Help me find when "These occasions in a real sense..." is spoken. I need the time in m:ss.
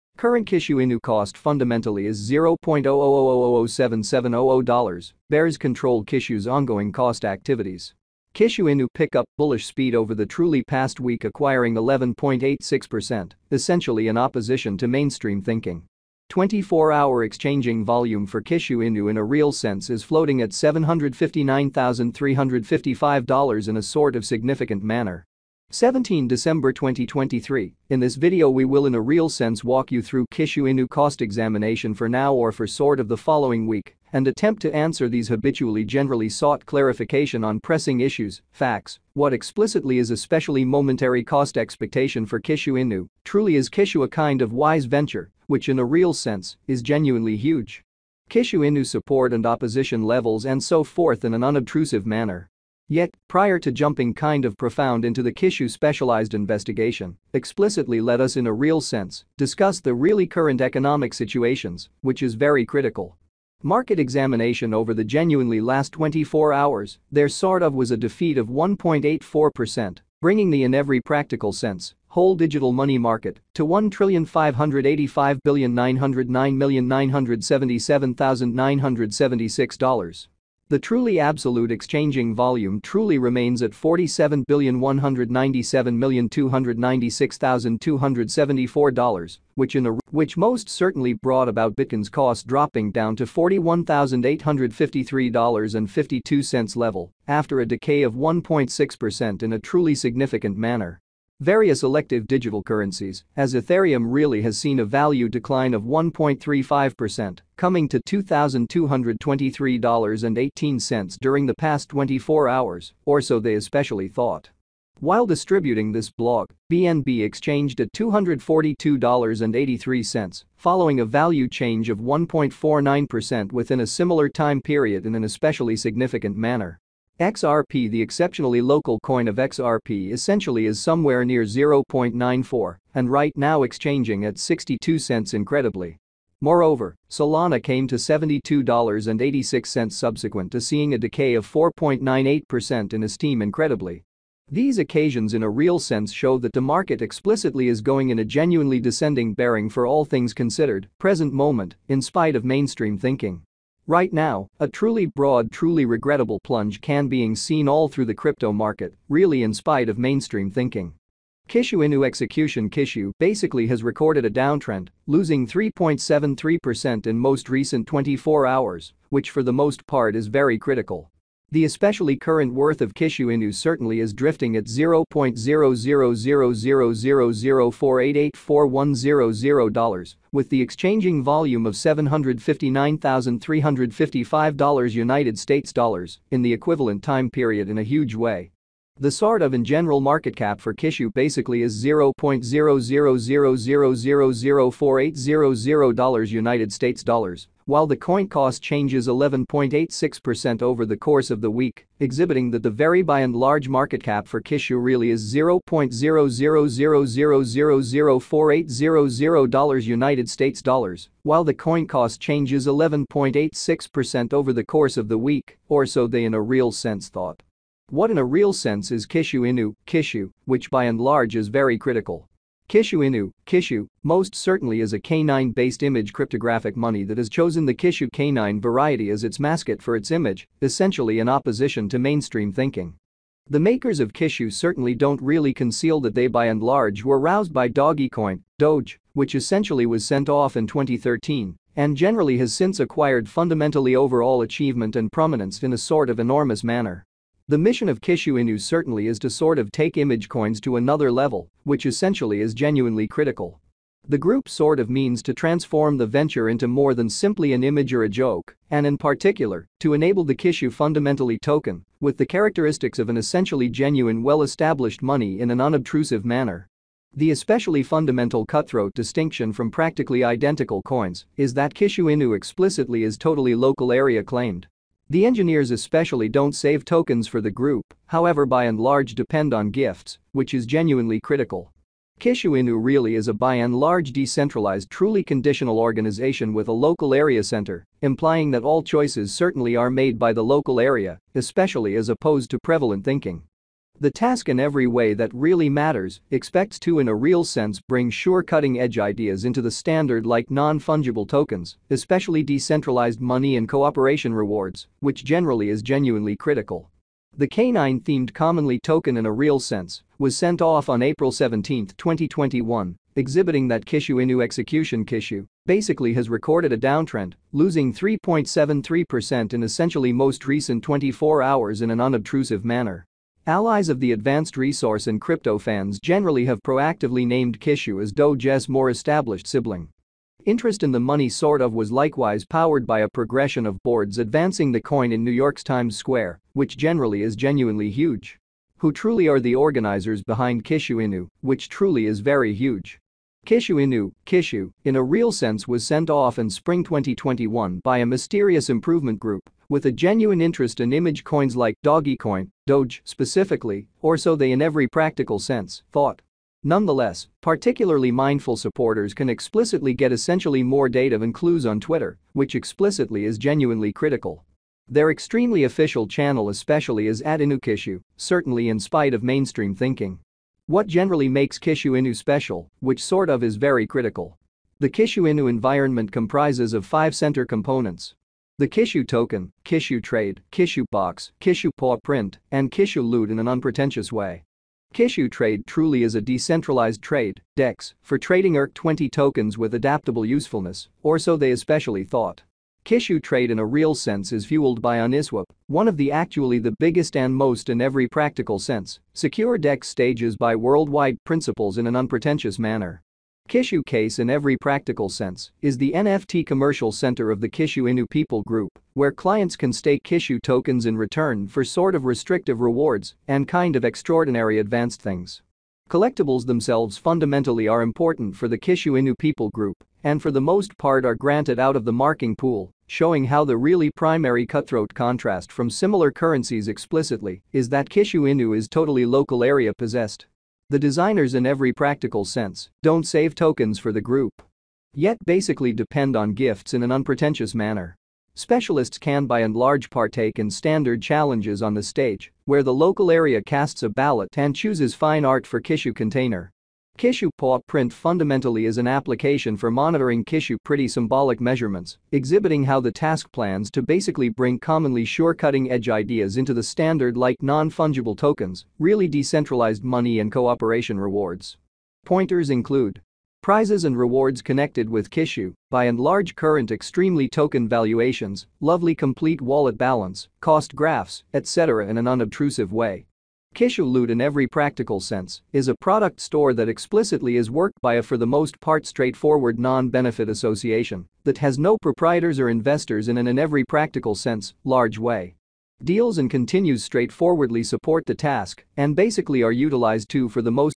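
2:24.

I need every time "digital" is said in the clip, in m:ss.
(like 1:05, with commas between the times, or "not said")
1:12, 1:42.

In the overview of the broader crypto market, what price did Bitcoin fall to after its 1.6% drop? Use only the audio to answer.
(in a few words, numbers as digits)
$41,853.52.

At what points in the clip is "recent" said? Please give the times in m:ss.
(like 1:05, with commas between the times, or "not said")
2:47, 5:20.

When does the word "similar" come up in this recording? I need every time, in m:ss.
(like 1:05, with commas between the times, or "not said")
2:03, 7:05.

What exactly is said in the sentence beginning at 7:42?
Pointers include Prizes and rewards connected with Kishu, by and large current extremely token valuations, lovely complete wallet balance, cost graphs, etc.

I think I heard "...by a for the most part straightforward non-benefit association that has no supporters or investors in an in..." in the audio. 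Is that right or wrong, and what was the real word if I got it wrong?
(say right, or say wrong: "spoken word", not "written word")
wrong: "proprietors", not "supporters".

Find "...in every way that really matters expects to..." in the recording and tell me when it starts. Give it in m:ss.
4:54.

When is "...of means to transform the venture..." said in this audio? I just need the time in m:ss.
4:14.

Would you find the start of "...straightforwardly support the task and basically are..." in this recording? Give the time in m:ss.
8:06.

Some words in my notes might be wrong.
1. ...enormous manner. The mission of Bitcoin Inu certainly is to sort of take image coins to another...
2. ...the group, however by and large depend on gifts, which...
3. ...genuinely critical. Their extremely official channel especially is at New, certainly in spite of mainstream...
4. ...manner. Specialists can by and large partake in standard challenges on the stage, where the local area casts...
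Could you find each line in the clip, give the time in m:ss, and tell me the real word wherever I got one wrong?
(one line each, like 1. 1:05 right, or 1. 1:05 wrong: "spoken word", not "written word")
1. 4:06 wrong: "Kishu", not "Bitcoin"
2. 4:37 right
3. 6:03 wrong: "Inukishu", not "New"
4. 7:17 right.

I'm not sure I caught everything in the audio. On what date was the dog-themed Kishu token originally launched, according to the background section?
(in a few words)
April 17, 2021.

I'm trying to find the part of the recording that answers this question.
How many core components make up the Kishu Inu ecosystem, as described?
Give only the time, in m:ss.
6:16.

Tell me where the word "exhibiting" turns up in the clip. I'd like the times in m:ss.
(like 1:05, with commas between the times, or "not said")
3:21, 5:13, 7:32.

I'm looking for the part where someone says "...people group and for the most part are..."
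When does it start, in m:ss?
6:59.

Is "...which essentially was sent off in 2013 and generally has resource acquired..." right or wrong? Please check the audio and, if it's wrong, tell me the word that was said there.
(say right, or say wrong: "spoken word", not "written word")
wrong: "since", not "resource".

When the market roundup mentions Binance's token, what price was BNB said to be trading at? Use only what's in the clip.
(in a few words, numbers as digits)
$242.83.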